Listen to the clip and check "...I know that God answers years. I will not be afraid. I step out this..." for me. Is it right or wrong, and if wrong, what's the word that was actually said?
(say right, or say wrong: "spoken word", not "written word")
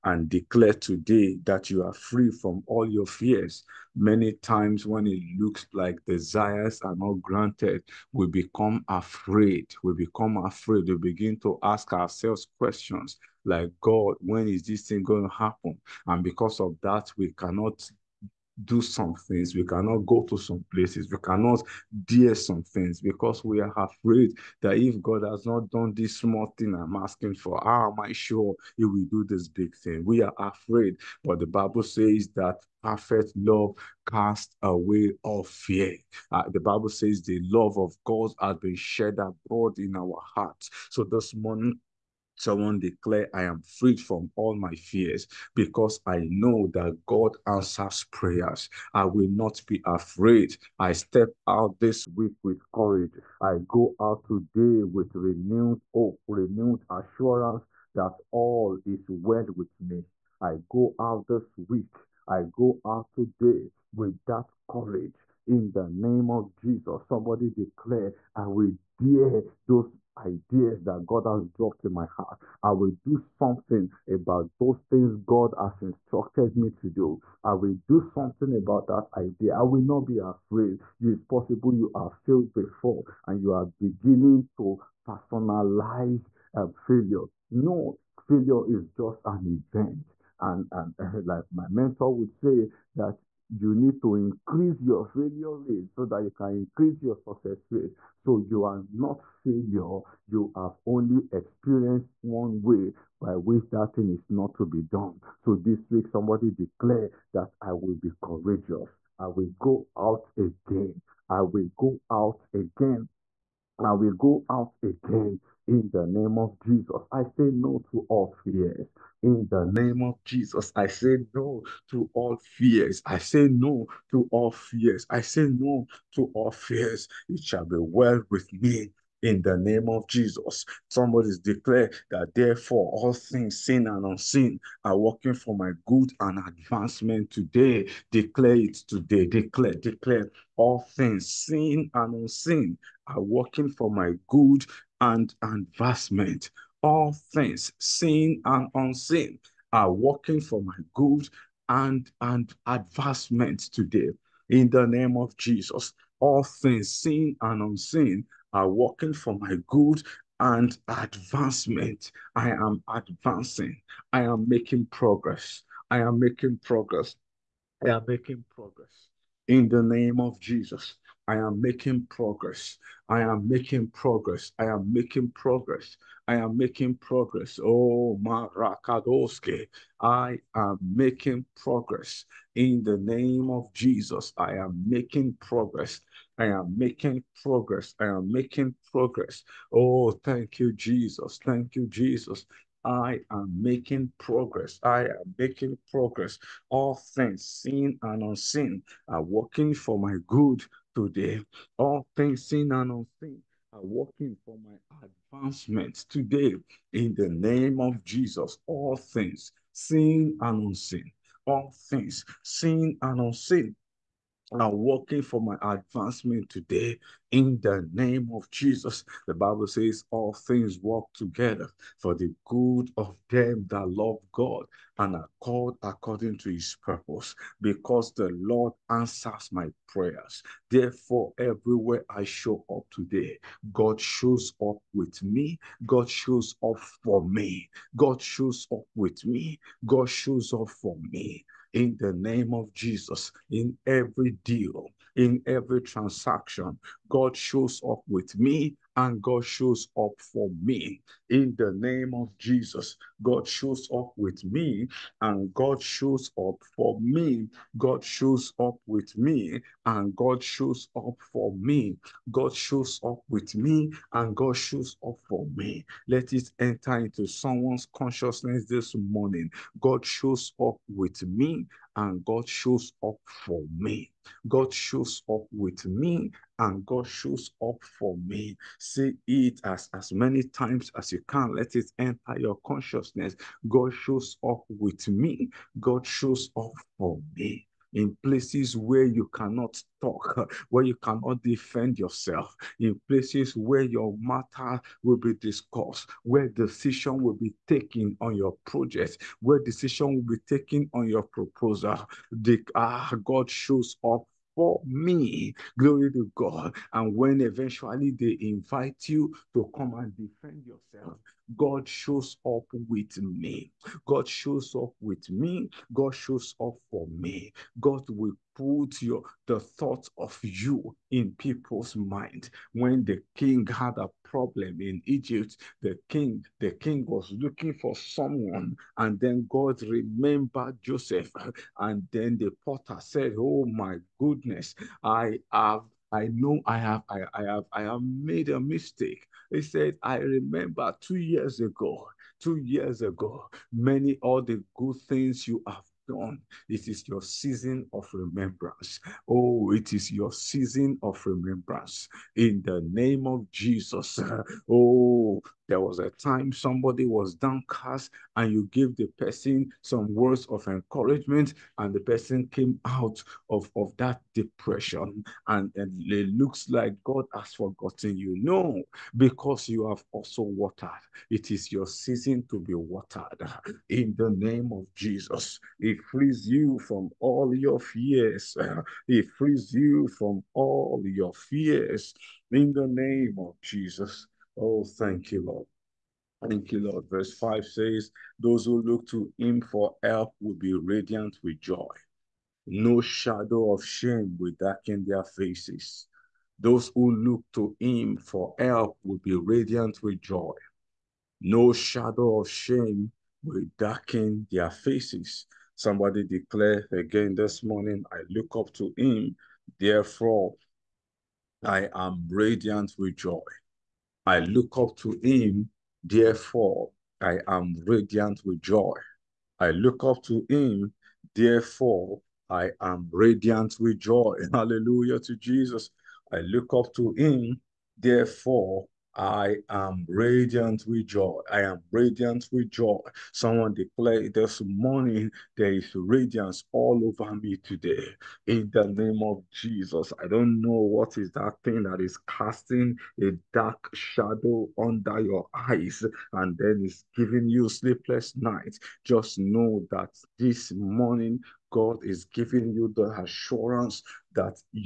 wrong: "prayers", not "years".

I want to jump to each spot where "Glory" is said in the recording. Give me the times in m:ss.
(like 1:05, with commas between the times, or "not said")
5:05.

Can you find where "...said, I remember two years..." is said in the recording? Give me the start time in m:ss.
5:39.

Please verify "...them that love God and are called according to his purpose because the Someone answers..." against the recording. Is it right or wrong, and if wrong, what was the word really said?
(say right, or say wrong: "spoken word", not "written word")
wrong: "Lord", not "Someone".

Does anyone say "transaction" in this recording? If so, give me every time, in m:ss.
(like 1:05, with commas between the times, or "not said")
4:05.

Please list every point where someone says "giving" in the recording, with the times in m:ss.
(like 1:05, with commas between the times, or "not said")
7:27, 7:32.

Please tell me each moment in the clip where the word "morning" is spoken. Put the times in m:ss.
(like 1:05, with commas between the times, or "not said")
0:41, 4:28, 6:47, 7:14, 7:30.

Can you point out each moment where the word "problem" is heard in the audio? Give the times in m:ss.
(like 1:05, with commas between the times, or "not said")
5:24.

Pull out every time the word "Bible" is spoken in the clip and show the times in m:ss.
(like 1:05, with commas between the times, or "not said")
0:31, 0:36, 3:39.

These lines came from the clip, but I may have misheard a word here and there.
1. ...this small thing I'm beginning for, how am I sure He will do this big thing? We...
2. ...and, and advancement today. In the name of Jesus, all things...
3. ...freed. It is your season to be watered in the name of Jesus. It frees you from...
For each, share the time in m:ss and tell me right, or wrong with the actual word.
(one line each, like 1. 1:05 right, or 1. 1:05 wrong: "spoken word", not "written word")
1. 0:25 wrong: "asking", not "beginning"
2. 2:31 right
3. 6:10 wrong: "watered", not "freed".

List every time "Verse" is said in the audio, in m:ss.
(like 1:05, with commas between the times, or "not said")
6:27.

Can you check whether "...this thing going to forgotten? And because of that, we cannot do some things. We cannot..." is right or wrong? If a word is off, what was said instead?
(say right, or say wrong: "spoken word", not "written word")
wrong: "happen", not "forgotten".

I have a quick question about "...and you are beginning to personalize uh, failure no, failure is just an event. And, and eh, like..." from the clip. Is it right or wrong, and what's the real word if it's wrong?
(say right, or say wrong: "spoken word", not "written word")
right.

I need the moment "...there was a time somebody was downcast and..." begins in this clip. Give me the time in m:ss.
5:55.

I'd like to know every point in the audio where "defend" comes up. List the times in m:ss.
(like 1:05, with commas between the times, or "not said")
4:51, 5:10.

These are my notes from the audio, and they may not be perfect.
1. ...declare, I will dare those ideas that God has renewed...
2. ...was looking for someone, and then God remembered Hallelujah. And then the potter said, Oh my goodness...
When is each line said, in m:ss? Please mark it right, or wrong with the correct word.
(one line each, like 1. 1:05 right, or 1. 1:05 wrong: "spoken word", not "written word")
1. 1:07 wrong: "dropped", not "renewed"
2. 5:27 wrong: "Joseph", not "Hallelujah".